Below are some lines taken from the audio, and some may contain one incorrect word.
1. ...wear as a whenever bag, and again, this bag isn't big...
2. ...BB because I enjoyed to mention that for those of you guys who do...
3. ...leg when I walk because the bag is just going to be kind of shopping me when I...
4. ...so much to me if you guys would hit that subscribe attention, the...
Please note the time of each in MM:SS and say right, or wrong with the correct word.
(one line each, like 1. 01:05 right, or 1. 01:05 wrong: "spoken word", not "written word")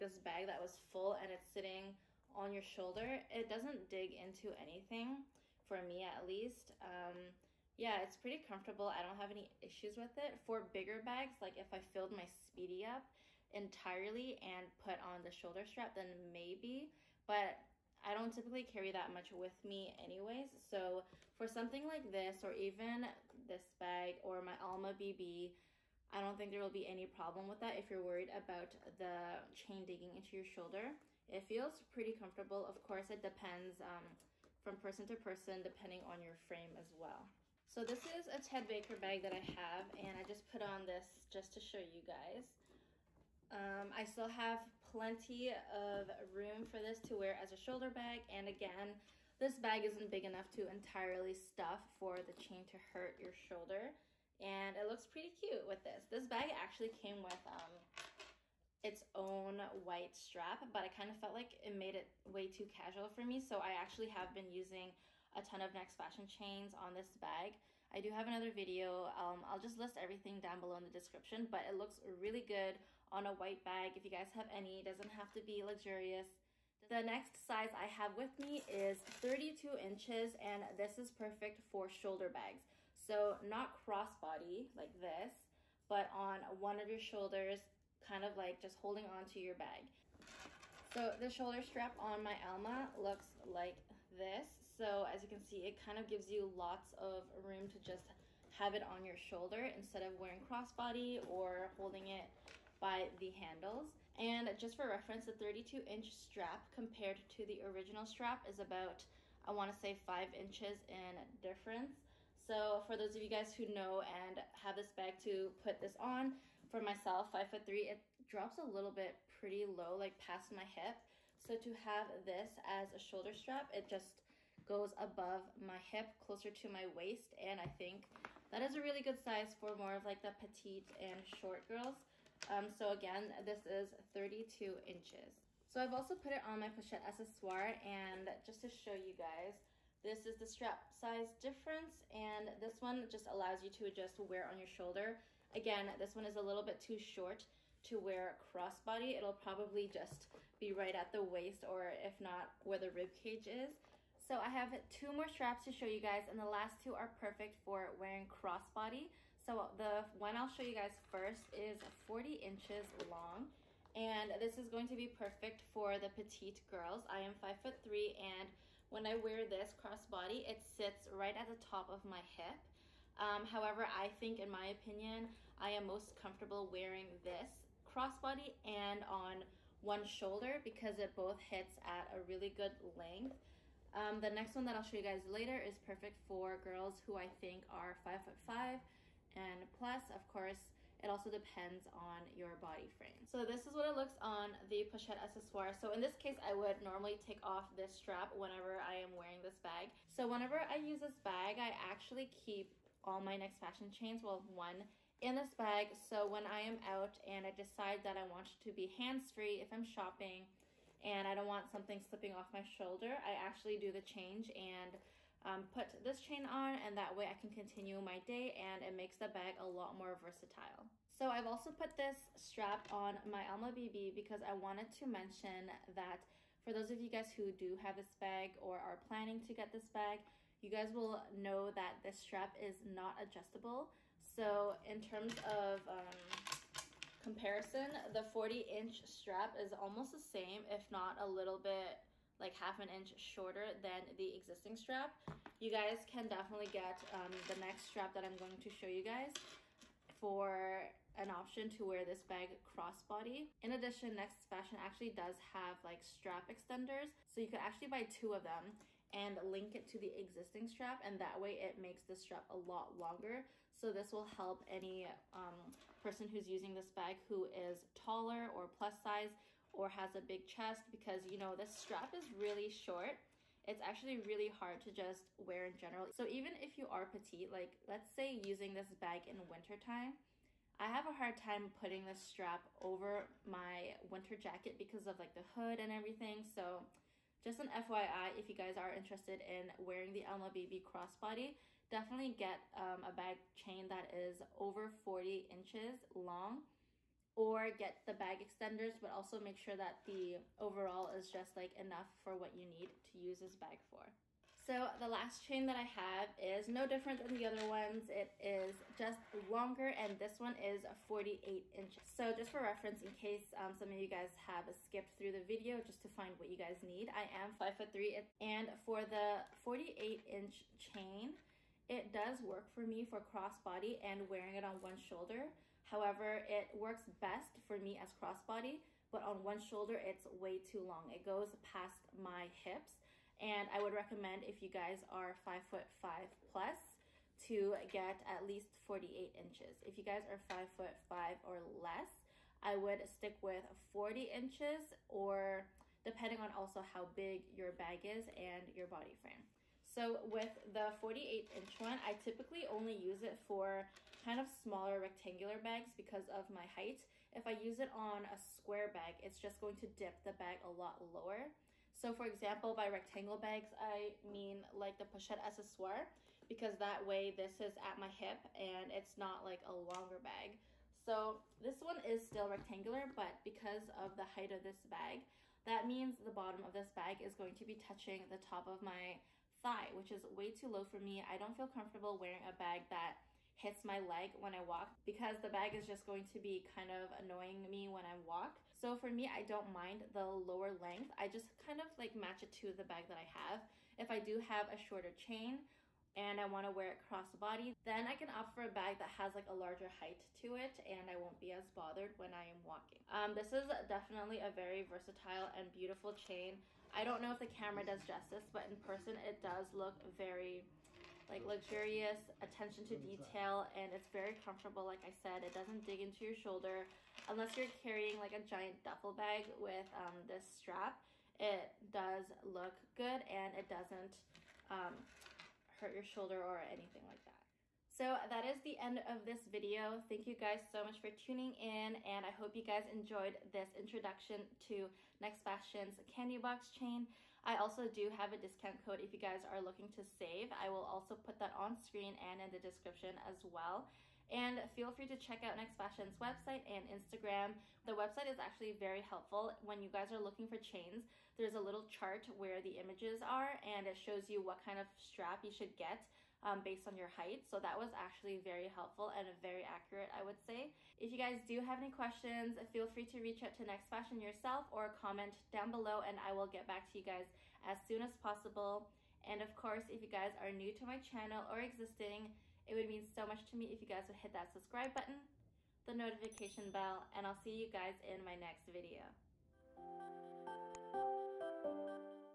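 1. 00:47 wrong: "shoulder", not "whenever"
2. 03:43 wrong: "wanted", not "enjoyed"
3. 06:23 wrong: "annoying", not "shopping"
4. 07:53 wrong: "button", not "attention".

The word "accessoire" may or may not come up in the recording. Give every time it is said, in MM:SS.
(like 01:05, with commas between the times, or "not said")
02:17, 03:15, 06:05.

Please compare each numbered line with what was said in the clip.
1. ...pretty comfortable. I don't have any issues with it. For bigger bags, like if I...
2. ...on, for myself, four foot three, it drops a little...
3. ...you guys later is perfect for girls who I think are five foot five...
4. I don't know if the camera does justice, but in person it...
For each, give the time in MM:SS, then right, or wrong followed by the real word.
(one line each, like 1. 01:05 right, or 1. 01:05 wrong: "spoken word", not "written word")
1. 00:08 right
2. 01:55 wrong: "five", not "four"
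3. 03:04 right
4. 06:46 right.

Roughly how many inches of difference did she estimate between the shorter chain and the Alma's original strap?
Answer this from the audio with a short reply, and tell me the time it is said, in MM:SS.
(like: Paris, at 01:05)
5, at 01:49.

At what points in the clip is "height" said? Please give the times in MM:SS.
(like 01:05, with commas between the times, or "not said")
05:56, 06:14, 06:39, 07:37.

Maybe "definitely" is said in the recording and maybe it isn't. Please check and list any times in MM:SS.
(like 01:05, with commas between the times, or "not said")
04:06, 04:51, 06:43.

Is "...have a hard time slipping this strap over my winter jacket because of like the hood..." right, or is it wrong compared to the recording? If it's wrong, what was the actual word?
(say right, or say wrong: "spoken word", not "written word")
wrong: "putting", not "slipping".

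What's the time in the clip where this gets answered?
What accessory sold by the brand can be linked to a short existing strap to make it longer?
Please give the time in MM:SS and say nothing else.
04:16.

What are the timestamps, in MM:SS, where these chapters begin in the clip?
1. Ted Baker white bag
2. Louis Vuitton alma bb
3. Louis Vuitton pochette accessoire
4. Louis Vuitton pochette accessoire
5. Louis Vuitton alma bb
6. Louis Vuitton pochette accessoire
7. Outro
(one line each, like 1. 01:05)
1. 00:37
2. 01:29
3. 02:15
4. 02:50
5. 03:41
6. 05:18
7. 07:07.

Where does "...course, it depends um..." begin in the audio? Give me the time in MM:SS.
00:32.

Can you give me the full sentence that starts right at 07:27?
The website is actually very helpful when you guys are looking for chains.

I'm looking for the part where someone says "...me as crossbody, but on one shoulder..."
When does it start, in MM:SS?
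05:27.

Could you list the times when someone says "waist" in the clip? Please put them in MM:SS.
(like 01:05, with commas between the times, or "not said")
02:06, 02:31.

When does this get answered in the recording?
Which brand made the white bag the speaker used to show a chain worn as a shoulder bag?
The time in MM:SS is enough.
00:38.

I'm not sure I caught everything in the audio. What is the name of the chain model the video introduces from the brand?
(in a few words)
candy box chain.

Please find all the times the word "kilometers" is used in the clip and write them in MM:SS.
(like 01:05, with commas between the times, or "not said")
not said.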